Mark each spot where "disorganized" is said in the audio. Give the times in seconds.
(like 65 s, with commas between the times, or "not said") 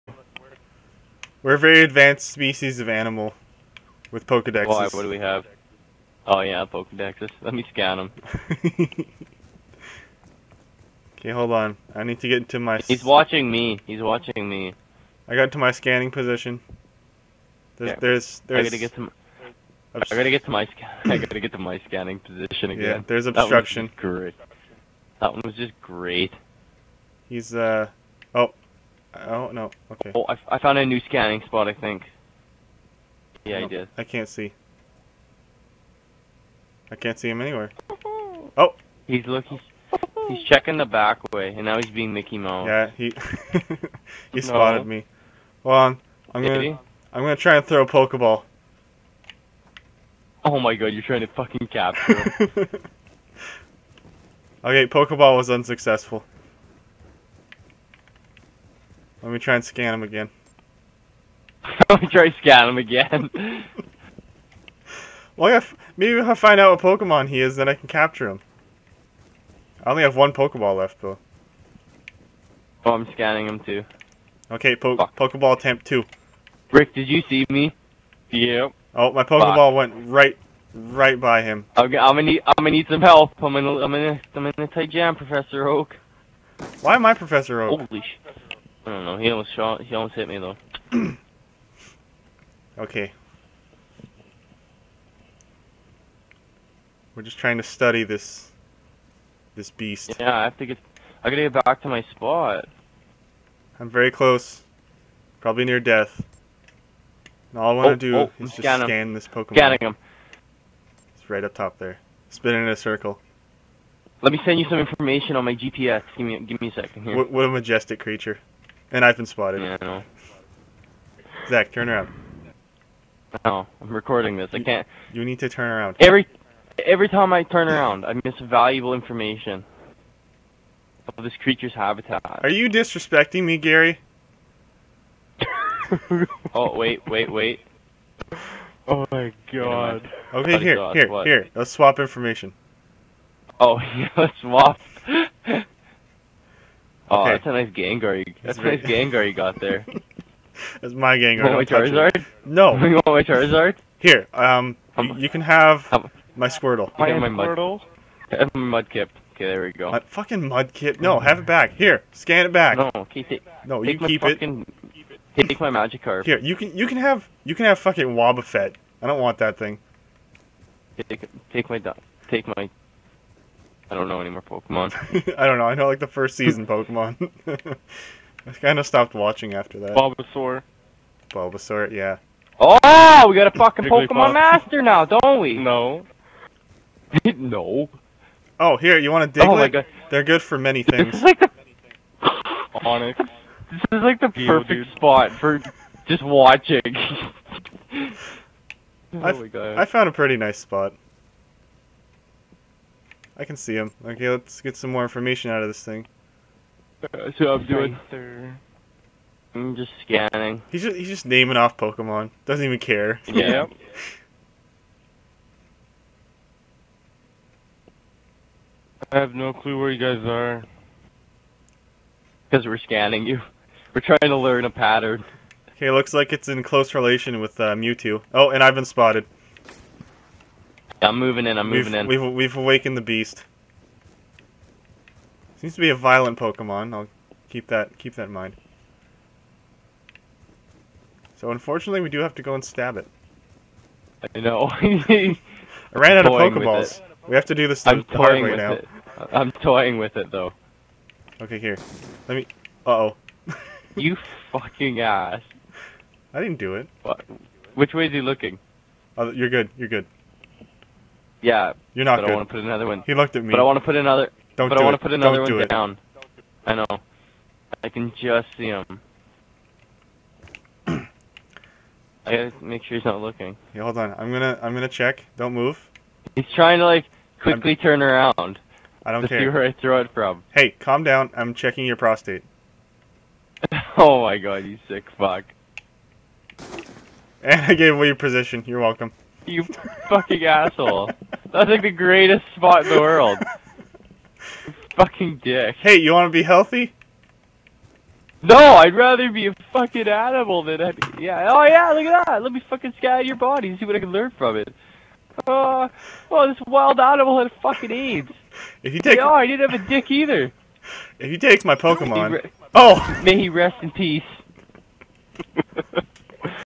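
not said.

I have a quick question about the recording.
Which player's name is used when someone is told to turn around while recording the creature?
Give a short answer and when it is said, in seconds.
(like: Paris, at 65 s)
Zach, at 121 s.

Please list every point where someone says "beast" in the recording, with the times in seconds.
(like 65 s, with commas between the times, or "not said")
99 s, 233 s.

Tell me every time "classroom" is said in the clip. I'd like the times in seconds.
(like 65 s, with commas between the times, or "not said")
not said.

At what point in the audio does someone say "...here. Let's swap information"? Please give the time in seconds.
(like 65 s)
141 s.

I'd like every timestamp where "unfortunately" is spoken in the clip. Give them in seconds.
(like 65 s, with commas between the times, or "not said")
241 s.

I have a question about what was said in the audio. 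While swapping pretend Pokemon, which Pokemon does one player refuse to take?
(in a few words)
Wobbuffet.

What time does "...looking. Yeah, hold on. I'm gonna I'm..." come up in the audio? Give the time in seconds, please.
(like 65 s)
273 s.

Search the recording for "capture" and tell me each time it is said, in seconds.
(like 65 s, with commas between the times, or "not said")
51 s, 67 s.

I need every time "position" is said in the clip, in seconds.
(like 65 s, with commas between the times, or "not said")
16 s, 22 s, 288 s.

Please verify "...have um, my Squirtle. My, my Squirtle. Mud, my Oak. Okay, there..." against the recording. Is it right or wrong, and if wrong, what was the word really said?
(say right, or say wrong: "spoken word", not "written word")
wrong: "Mudkip", not "Oak".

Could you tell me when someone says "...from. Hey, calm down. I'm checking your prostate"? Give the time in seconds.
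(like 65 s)
280 s.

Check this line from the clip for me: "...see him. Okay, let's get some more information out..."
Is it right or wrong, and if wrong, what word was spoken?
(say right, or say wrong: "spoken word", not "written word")
right.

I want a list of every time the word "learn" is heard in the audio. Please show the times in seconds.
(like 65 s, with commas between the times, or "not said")
224 s, 304 s.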